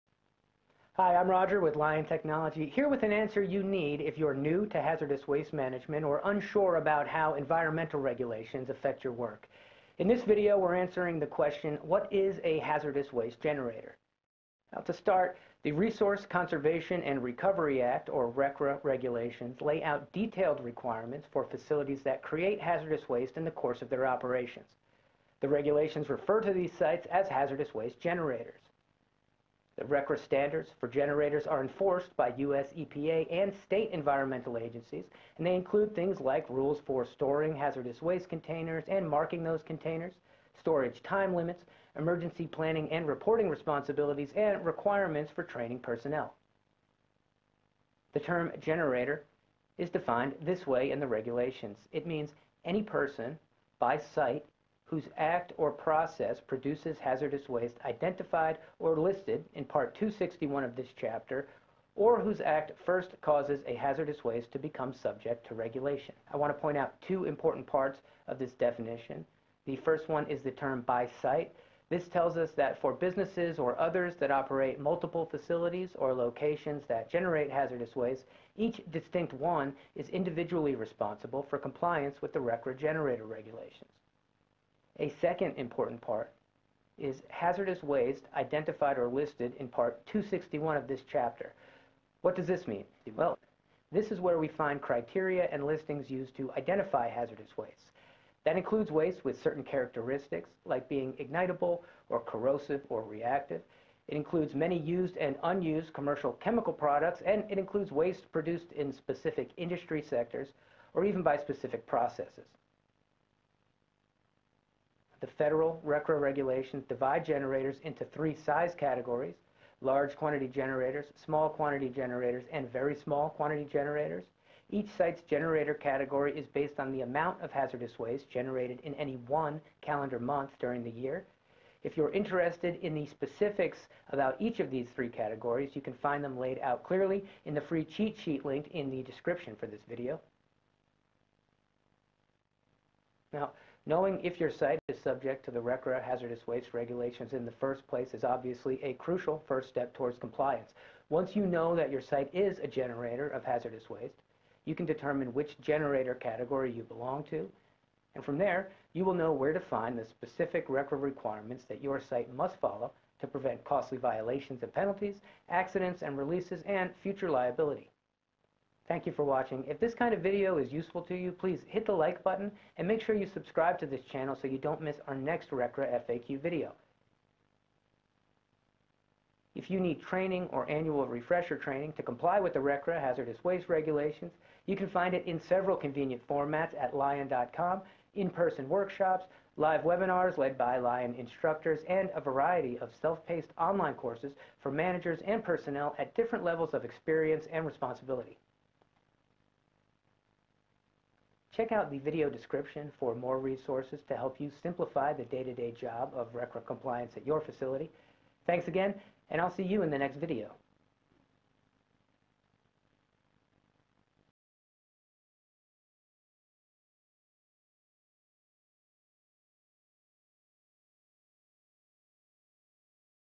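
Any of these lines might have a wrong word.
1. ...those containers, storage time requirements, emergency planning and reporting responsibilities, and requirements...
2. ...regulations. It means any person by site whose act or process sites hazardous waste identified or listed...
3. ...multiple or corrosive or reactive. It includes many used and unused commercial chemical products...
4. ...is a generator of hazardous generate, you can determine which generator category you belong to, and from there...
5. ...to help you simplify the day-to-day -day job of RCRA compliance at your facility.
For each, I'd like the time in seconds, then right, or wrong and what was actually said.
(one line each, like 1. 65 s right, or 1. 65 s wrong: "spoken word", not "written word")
1. 39 s wrong: "limits", not "requirements"
2. 51 s wrong: "produces", not "sites"
3. 101 s wrong: "ignitable", not "multiple"
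4. 152 s wrong: "waste", not "generate"
5. 204 s right.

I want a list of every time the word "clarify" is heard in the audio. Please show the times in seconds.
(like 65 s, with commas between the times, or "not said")
not said.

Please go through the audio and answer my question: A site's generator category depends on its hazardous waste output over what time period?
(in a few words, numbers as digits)
any one calendar month.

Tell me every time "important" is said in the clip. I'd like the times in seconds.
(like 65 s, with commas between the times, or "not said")
67 s, 85 s.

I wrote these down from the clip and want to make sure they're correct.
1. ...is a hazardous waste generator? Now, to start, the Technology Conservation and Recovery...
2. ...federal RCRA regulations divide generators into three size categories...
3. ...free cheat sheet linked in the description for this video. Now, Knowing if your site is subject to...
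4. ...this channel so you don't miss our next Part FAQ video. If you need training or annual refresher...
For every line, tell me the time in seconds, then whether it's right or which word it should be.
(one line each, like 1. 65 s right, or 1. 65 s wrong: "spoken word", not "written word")
1. 12 s wrong: "Resource", not "Technology"
2. 115 s right
3. 137 s right
4. 173 s wrong: "RCRA", not "Part".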